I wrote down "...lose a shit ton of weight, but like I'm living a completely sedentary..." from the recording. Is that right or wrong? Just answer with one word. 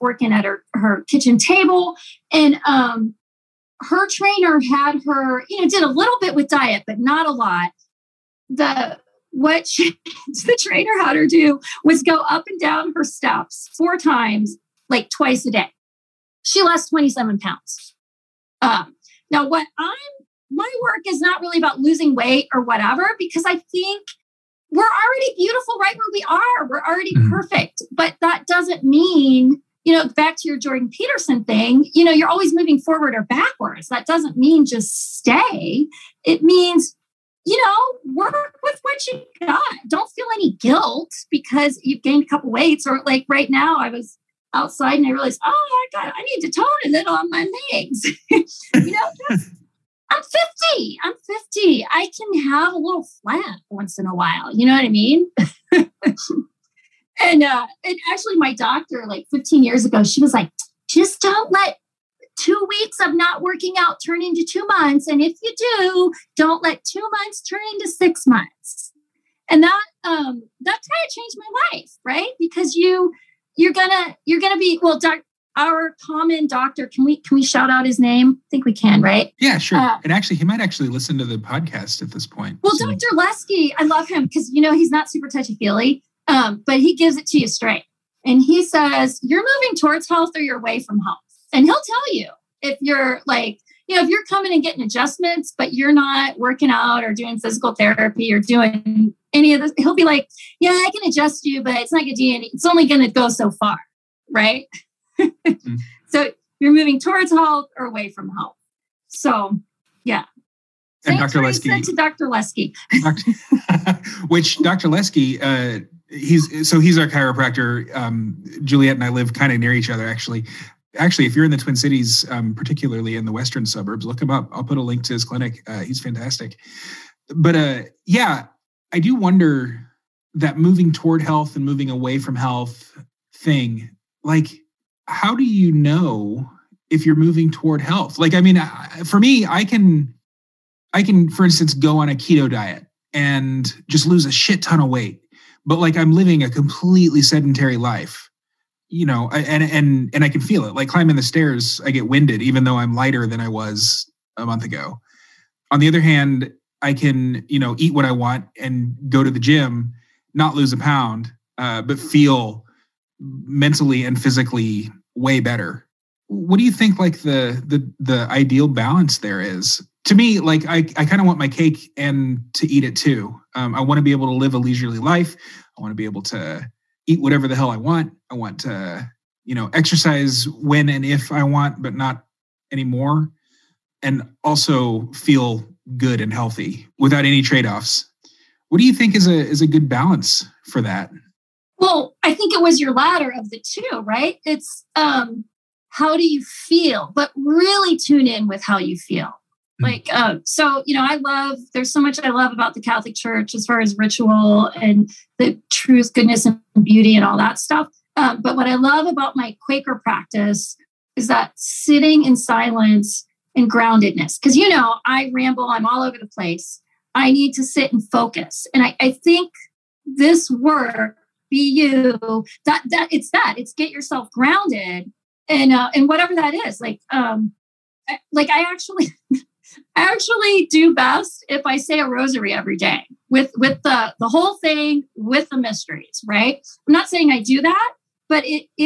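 right.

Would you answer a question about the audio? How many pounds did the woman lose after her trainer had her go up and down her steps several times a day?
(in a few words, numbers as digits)
27.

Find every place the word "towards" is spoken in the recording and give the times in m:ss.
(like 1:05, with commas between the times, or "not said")
1:29, 1:46, 2:10, 2:17.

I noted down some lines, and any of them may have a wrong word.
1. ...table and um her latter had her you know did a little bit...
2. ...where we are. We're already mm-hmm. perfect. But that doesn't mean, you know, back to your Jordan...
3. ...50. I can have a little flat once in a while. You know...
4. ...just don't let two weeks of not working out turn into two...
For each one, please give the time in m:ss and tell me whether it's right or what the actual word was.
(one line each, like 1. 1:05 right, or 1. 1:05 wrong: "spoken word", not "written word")
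1. 0:01 wrong: "trainer", not "latter"
2. 0:25 right
3. 0:51 right
4. 1:00 right.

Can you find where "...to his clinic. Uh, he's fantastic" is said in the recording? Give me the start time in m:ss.
2:05.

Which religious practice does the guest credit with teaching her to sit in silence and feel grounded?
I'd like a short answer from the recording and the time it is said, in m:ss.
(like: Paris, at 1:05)
Quaker, at 3:29.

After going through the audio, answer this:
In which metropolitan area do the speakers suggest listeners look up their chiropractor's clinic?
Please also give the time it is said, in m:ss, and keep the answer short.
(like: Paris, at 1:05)
Twin Cities, at 2:01.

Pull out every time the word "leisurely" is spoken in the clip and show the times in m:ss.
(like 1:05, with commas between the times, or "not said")
2:54.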